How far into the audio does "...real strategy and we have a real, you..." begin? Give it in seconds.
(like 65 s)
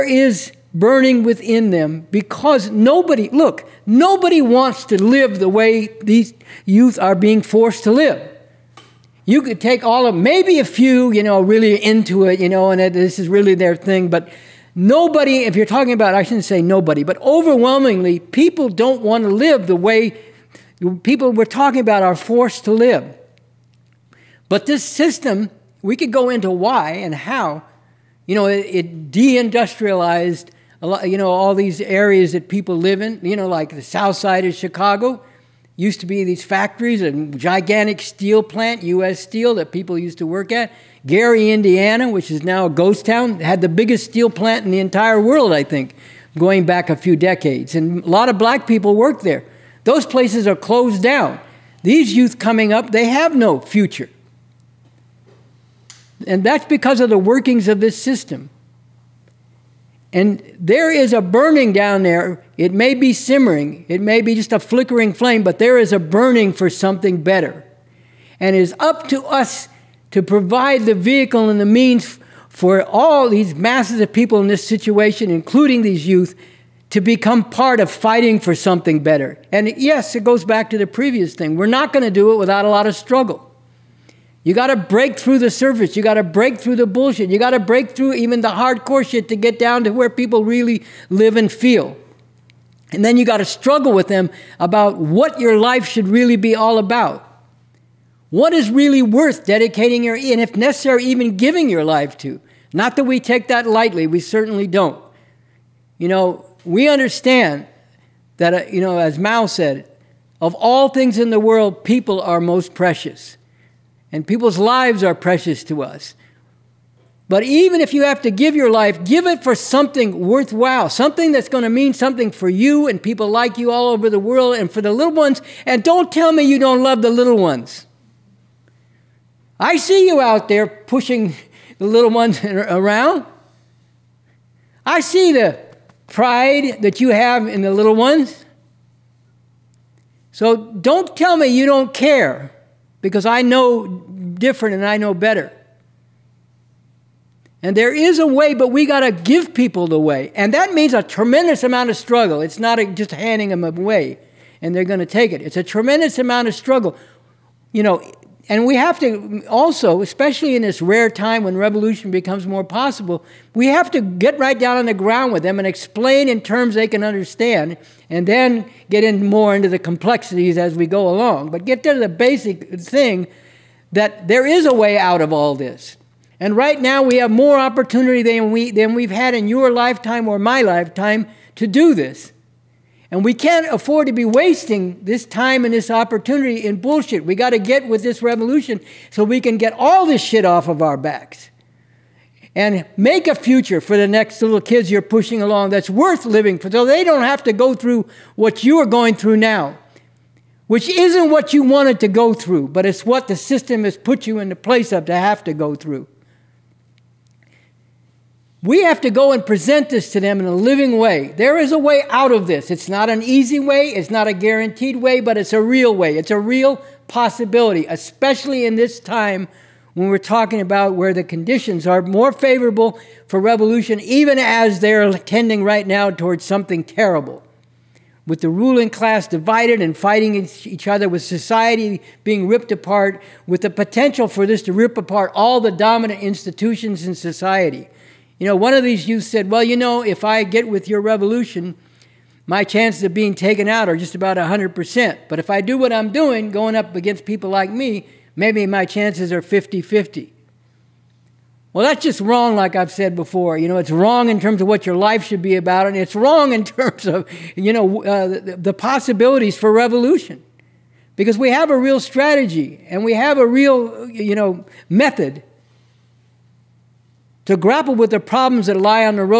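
261 s.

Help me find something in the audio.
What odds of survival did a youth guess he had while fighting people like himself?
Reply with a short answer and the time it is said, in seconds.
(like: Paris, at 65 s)
50-50, at 249 s.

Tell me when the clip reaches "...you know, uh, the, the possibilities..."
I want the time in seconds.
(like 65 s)
257 s.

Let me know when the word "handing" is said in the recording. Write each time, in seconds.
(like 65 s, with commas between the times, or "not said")
153 s.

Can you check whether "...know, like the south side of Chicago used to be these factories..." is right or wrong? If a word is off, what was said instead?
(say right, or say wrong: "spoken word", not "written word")
right.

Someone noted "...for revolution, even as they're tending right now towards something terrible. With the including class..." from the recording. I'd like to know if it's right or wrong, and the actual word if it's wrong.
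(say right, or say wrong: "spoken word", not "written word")
wrong: "ruling", not "including".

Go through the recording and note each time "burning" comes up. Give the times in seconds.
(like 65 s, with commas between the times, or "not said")
0 s, 61 s, 65 s.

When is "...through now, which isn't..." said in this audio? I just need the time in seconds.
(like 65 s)
199 s.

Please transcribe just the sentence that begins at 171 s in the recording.
But get to the basic thing that there is a way out of all this.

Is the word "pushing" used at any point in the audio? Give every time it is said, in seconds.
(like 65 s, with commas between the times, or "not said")
130 s, 195 s.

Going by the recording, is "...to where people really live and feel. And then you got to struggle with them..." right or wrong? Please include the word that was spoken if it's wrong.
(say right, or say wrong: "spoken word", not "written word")
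right.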